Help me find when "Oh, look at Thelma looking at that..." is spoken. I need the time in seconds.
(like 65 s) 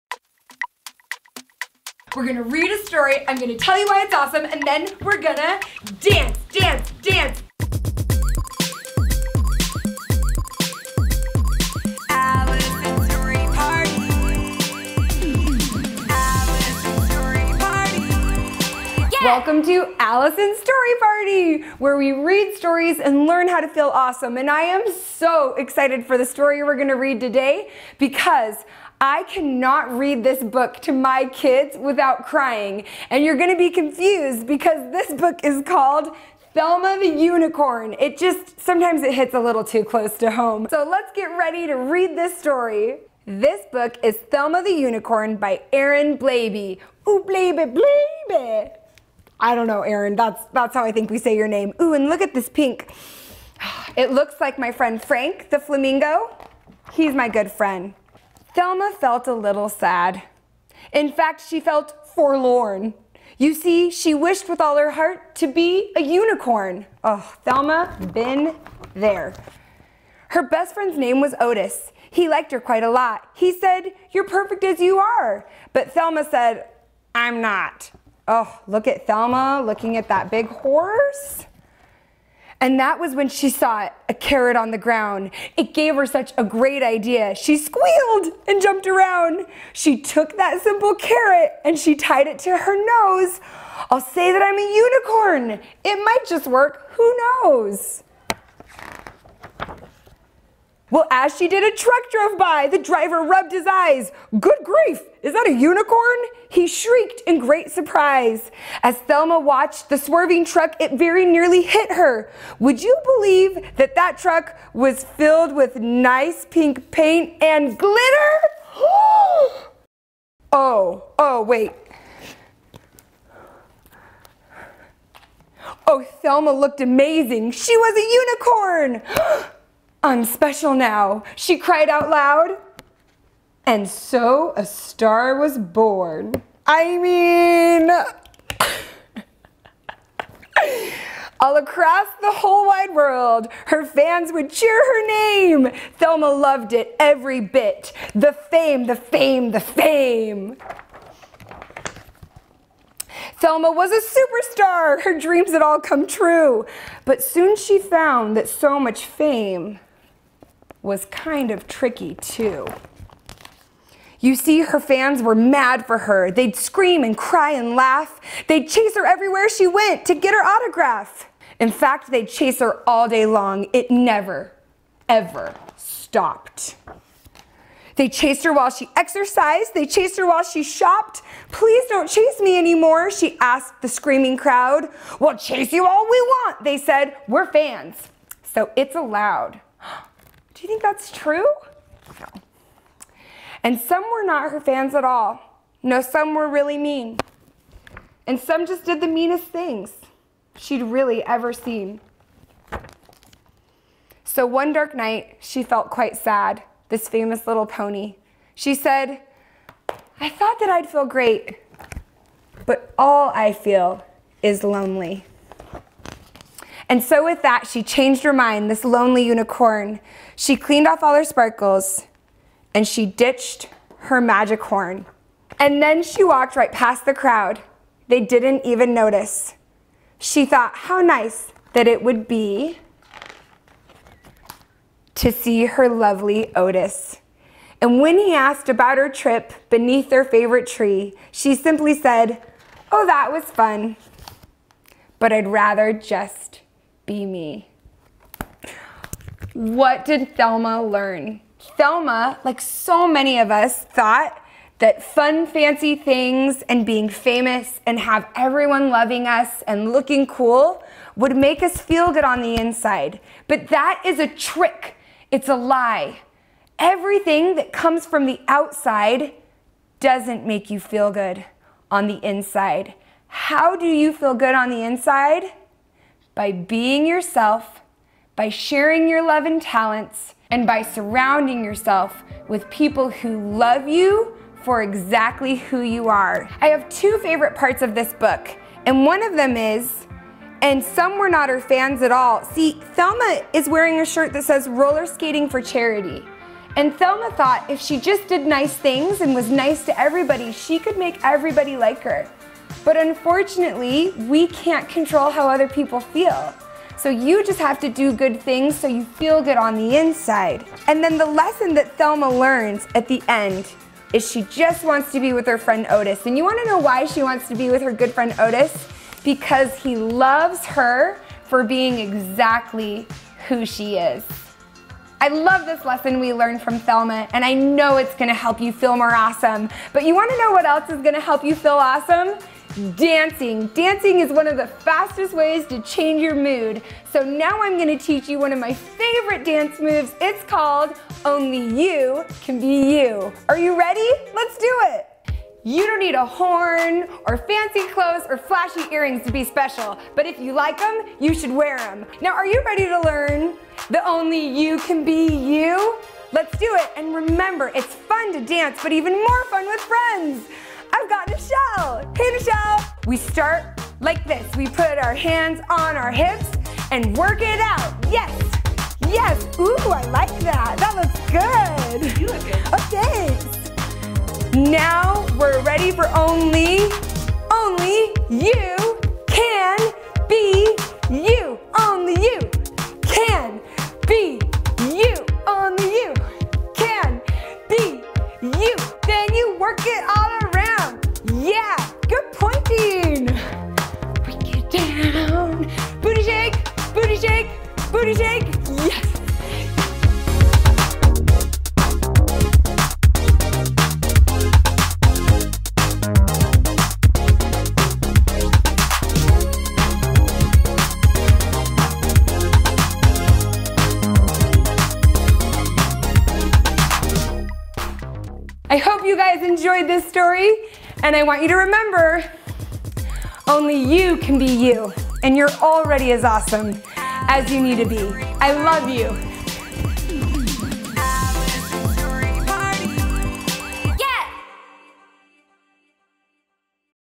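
78 s.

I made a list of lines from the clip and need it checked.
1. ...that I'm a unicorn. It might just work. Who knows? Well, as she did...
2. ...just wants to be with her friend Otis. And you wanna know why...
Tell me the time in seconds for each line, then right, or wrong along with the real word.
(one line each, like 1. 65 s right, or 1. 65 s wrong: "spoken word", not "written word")
1. 94 s right
2. 314 s right.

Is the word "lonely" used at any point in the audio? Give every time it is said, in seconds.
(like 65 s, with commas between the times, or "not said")
214 s, 218 s.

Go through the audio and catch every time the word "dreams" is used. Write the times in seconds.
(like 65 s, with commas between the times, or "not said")
155 s.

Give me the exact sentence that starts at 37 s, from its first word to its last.
It just, sometimes it hits a little too close to home.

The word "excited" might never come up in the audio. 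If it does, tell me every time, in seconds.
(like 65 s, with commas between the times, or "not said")
25 s.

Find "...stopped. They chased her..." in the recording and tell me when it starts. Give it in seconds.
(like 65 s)
175 s.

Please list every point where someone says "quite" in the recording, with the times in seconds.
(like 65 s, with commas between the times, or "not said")
72 s, 205 s.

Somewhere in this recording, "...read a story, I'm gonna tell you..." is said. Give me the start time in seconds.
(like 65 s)
2 s.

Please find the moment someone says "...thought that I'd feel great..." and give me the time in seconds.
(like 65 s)
210 s.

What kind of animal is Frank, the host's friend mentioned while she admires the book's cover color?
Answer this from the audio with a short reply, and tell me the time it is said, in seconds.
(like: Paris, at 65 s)
Flamingo, at 55 s.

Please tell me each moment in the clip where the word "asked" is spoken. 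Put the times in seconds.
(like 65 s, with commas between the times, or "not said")
183 s, 238 s.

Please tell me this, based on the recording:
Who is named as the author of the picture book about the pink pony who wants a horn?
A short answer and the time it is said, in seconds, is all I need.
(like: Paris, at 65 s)
Aaron Blabey, at 45 s.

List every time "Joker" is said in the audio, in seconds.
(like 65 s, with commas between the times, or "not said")
not said.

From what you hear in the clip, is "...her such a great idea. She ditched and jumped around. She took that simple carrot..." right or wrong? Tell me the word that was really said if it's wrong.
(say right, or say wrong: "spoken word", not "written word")
wrong: "squealed", not "ditched".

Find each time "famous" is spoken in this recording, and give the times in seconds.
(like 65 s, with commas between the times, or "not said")
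207 s, 257 s.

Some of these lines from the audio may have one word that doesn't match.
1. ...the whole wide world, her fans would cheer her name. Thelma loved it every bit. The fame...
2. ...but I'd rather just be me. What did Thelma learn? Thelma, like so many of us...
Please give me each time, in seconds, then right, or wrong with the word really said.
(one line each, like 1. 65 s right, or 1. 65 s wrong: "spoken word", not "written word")
1. 142 s right
2. 245 s right.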